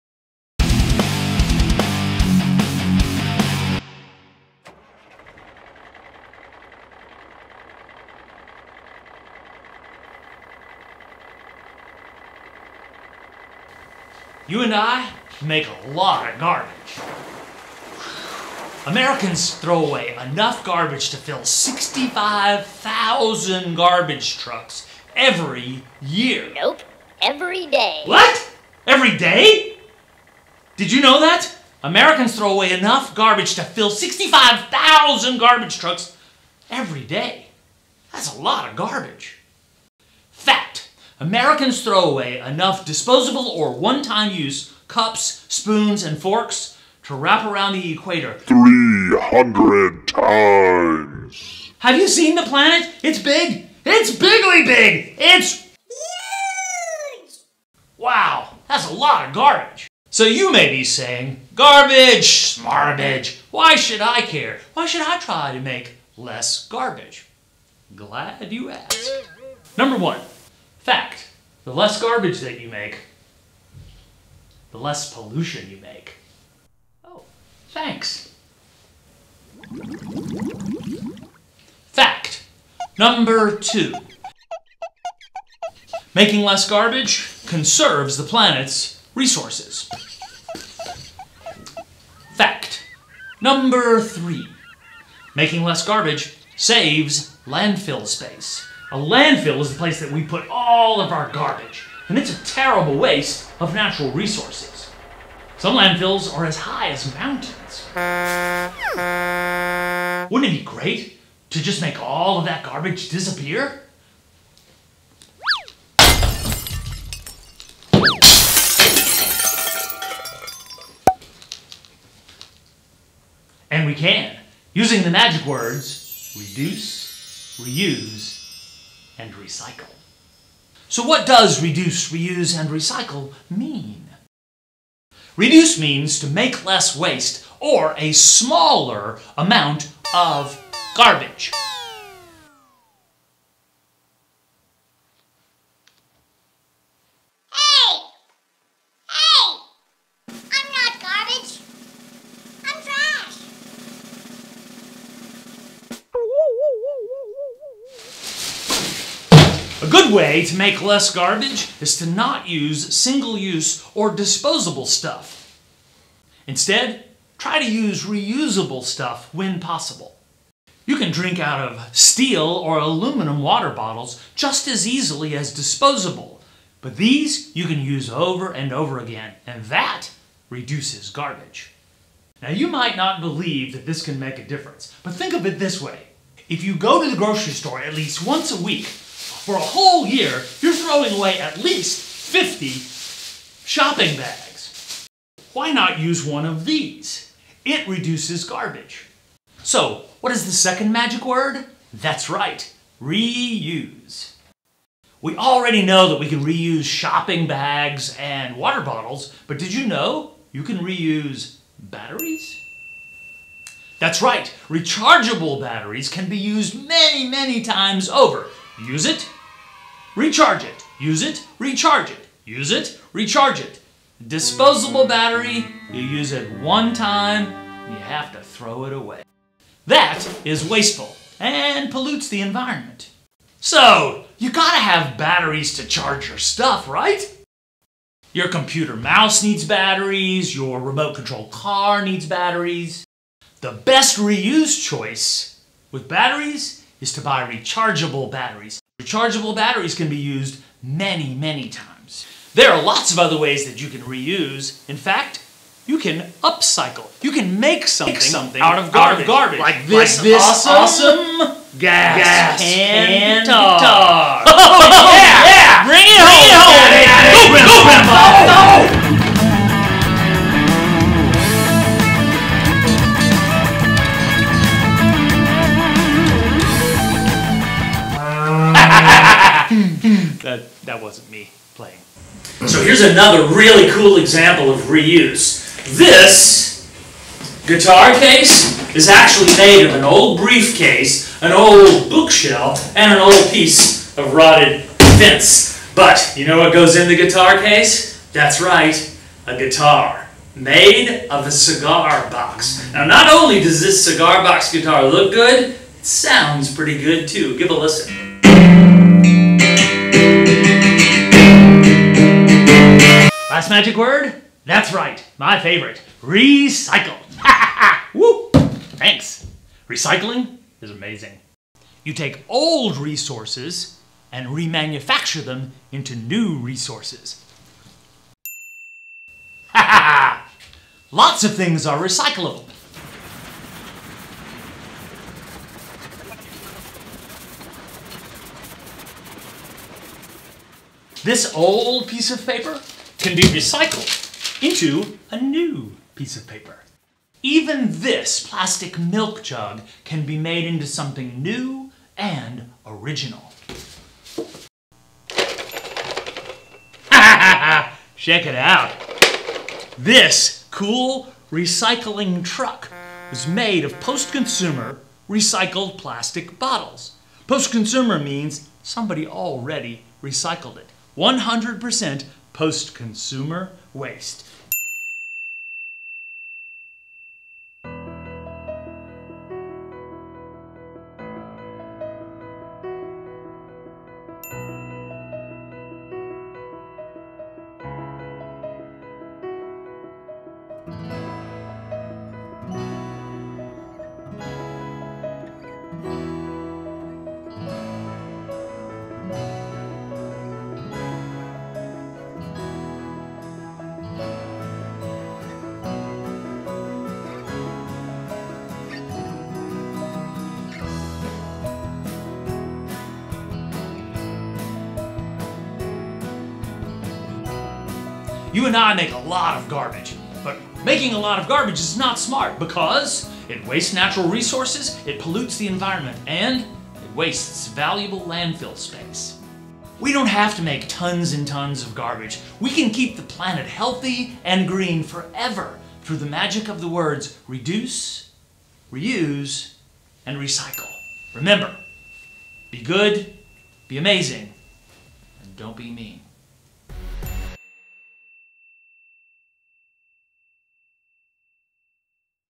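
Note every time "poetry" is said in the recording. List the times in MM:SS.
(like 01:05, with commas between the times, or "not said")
not said.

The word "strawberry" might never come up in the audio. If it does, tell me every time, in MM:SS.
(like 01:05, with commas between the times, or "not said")
not said.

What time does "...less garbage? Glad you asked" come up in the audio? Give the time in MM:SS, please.
01:06.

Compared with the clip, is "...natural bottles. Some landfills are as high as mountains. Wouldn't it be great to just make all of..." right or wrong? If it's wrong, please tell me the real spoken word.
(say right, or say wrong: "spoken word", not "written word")
wrong: "resources", not "bottles".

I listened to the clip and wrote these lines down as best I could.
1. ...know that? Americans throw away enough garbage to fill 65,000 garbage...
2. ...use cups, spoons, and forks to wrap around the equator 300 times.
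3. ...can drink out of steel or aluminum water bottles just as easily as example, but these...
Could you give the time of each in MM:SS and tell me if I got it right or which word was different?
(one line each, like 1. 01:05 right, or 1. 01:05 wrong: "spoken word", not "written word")
1. 00:31 right
2. 00:44 right
3. 02:50 wrong: "disposable", not "example".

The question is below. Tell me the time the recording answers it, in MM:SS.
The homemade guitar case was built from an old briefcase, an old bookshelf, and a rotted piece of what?
04:55.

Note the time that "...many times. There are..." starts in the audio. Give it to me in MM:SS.
04:11.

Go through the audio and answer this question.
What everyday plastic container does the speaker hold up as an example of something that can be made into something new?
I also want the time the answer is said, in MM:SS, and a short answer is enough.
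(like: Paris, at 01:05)
Milk jug, at 05:48.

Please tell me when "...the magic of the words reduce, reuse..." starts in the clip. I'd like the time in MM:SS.
07:16.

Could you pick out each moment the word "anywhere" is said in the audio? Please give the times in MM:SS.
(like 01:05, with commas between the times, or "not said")
not said.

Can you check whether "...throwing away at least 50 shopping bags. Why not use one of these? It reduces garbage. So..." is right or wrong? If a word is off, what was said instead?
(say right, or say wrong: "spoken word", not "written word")
right.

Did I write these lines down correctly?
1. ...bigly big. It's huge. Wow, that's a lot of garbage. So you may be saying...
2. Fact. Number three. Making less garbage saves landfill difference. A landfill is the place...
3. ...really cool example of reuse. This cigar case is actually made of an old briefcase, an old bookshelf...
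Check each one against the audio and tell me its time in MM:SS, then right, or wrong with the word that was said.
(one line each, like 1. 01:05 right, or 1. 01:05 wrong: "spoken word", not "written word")
1. 00:54 right
2. 01:32 wrong: "space", not "difference"
3. 04:43 wrong: "guitar", not "cigar".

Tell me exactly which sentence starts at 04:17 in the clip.
You can make something, make something out, of garbage.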